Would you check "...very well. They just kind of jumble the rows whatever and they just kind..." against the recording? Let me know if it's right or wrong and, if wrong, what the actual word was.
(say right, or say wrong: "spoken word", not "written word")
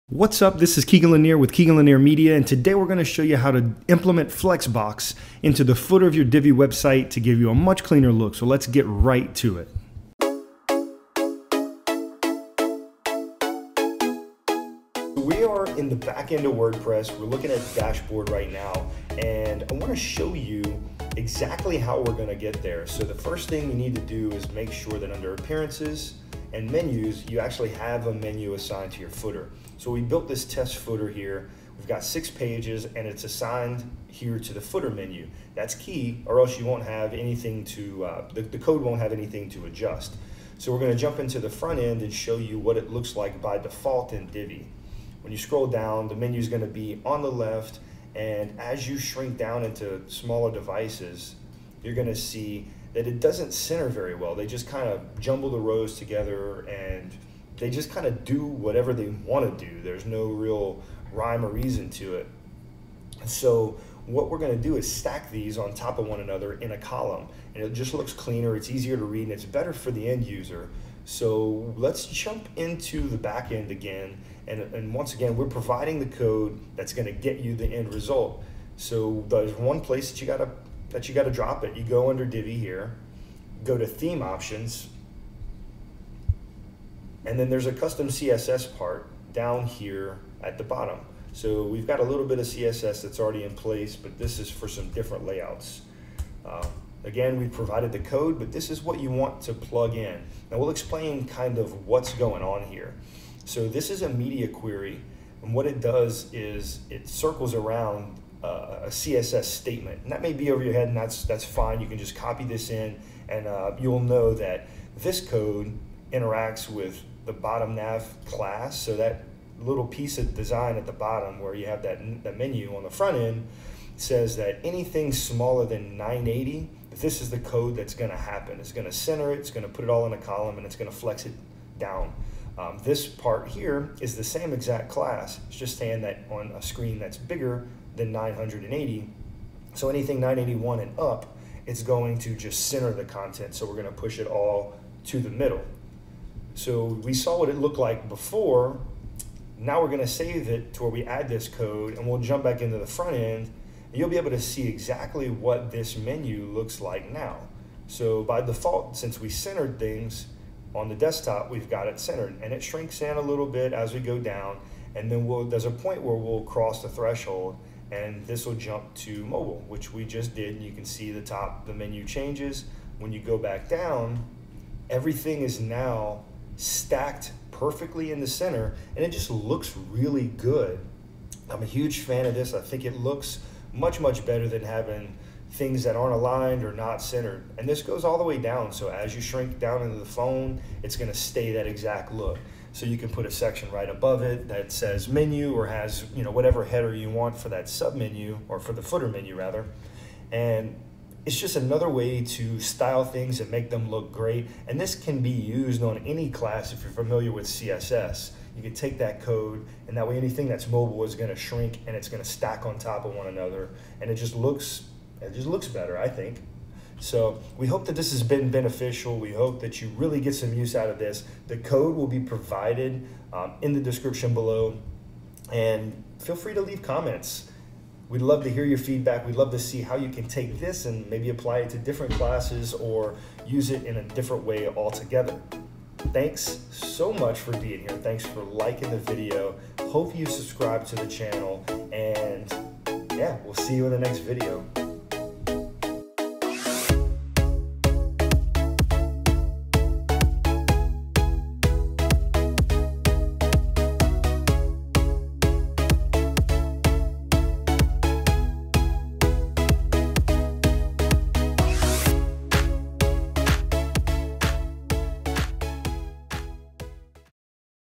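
wrong: "together", not "whatever".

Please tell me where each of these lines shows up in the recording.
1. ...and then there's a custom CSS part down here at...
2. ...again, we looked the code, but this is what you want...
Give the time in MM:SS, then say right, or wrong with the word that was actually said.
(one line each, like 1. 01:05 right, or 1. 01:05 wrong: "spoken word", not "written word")
1. 01:27 right
2. 01:37 wrong: "provided", not "looked".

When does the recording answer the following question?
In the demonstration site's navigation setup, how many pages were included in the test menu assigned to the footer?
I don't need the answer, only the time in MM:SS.
00:32.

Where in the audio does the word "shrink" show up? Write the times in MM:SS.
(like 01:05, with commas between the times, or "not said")
00:48, 02:42, 03:09, 03:31.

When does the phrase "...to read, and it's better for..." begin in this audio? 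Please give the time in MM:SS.
01:08.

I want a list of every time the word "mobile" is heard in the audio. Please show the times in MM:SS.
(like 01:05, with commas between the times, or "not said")
02:49, 03:30.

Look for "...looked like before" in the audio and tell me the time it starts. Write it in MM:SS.
02:27.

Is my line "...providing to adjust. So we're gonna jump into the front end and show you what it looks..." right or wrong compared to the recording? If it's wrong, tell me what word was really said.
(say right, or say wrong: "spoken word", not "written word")
wrong: "anything", not "providing".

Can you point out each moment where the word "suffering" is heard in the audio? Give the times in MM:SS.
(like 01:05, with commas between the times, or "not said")
not said.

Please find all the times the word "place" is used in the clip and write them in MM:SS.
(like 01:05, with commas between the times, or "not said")
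01:19, 01:33.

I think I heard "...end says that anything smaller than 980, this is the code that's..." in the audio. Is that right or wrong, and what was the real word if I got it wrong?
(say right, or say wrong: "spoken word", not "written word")
right.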